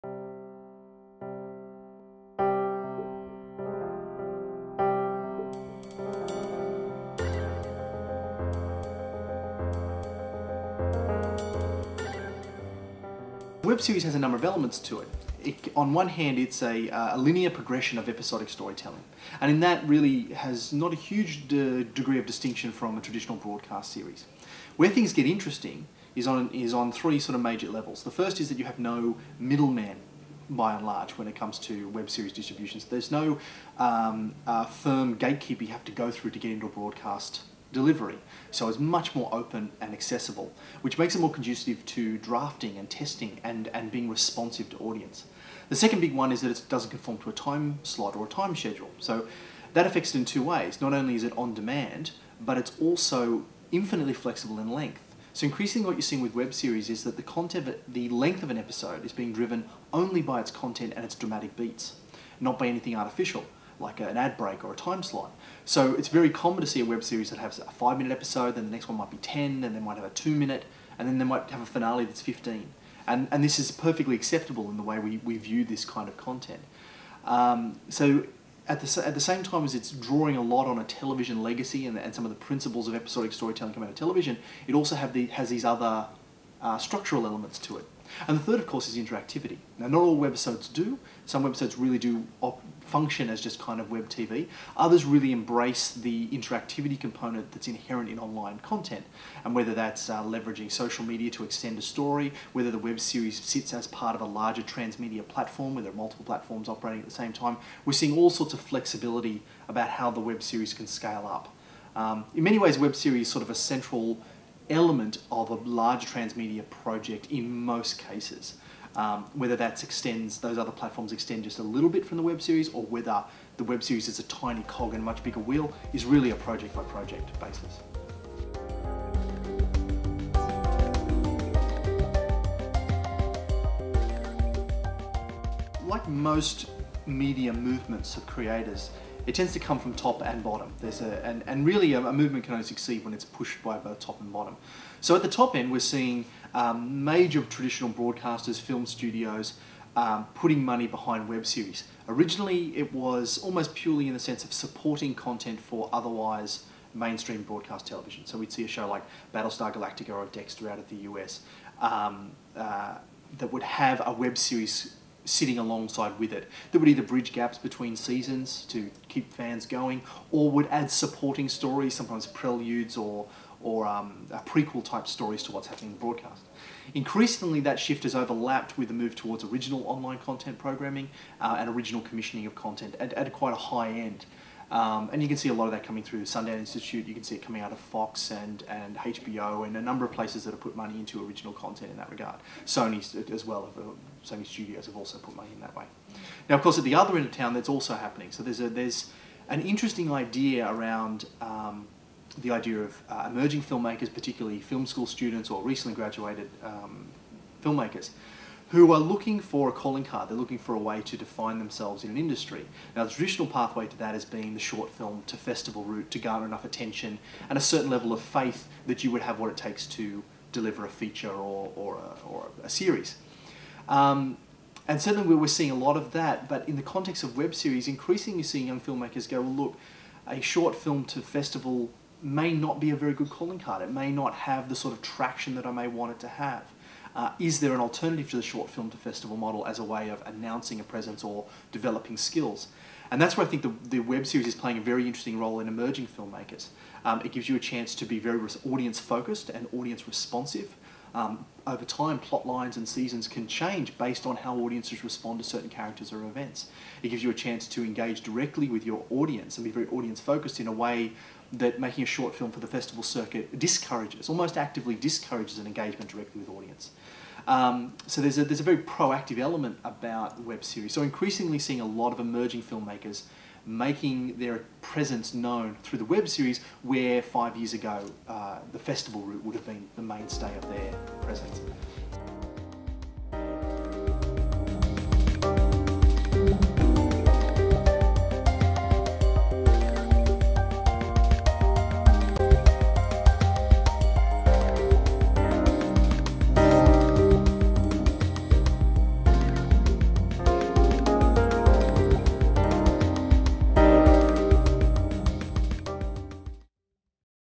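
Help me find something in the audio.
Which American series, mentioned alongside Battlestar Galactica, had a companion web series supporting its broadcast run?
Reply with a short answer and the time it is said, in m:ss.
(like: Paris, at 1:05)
Dexter, at 2:40.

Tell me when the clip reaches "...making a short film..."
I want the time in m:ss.
4:21.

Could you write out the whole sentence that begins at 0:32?
There's no um, uh, firm gatekeeper you have to go through to get into a broadcast delivery.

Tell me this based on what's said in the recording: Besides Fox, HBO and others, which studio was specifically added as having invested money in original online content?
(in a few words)
Sony Studios.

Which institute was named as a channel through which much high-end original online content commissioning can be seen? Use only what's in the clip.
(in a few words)
Sundance Institute.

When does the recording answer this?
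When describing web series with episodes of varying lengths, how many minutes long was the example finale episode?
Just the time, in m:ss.
1:12.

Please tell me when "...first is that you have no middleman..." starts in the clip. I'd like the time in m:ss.
0:28.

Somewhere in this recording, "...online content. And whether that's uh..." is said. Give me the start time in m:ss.
1:38.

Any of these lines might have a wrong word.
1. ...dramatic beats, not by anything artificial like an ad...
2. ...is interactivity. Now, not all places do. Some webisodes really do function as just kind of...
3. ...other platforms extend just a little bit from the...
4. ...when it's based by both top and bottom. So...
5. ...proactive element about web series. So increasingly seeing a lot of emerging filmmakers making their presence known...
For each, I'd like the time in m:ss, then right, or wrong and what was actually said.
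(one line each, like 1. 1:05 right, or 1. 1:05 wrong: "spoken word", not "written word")
1. 1:01 right
2. 1:28 wrong: "webisodes", not "places"
3. 2:00 right
4. 2:23 wrong: "pushed", not "based"
5. 4:28 right.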